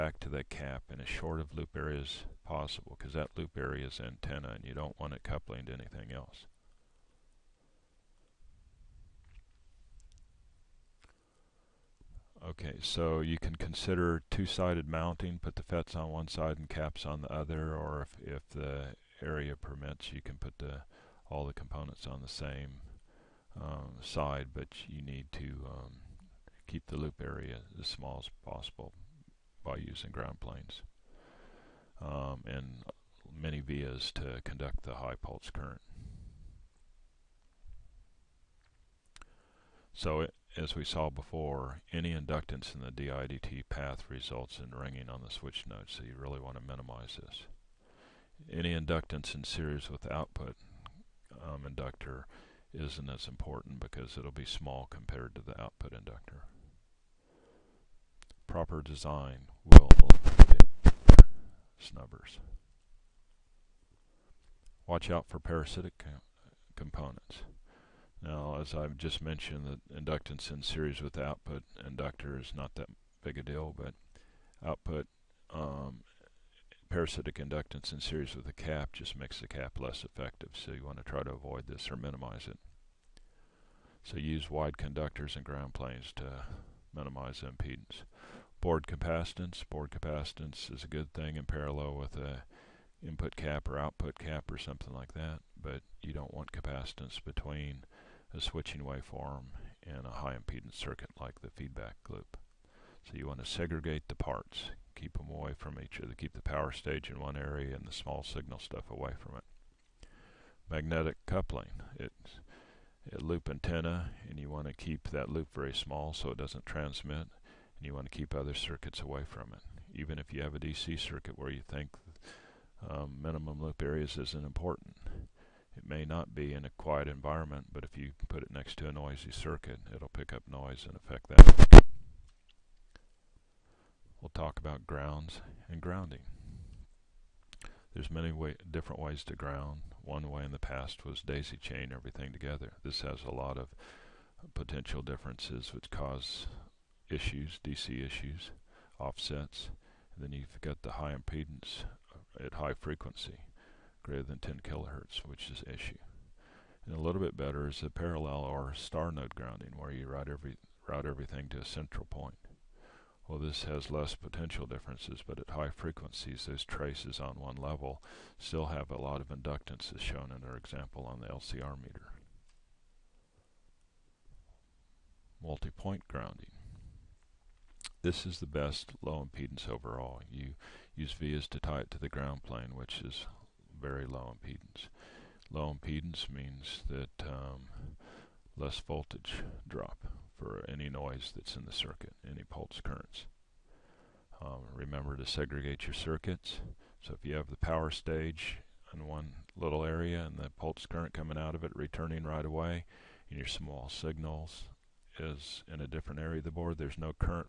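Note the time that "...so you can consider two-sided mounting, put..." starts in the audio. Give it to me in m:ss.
0:12.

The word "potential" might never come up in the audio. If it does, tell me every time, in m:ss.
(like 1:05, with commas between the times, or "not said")
2:24, 2:44.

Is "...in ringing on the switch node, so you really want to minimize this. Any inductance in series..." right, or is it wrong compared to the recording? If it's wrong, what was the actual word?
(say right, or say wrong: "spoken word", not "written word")
right.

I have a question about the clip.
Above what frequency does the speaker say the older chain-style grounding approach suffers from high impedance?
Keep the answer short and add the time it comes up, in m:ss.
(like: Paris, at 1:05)
10 kilohertz, at 2:34.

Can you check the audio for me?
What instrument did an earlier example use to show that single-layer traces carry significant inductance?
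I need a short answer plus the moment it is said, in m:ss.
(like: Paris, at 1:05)
LCR meter, at 2:51.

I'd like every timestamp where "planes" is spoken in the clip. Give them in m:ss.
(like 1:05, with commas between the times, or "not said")
0:30, 1:25, 3:02.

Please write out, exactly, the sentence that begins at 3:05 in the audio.
Low impedance means that um, less voltage drop for any noise that's in the circuit, any pulse currents.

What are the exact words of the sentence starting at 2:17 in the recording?
There's many way, different ways to ground.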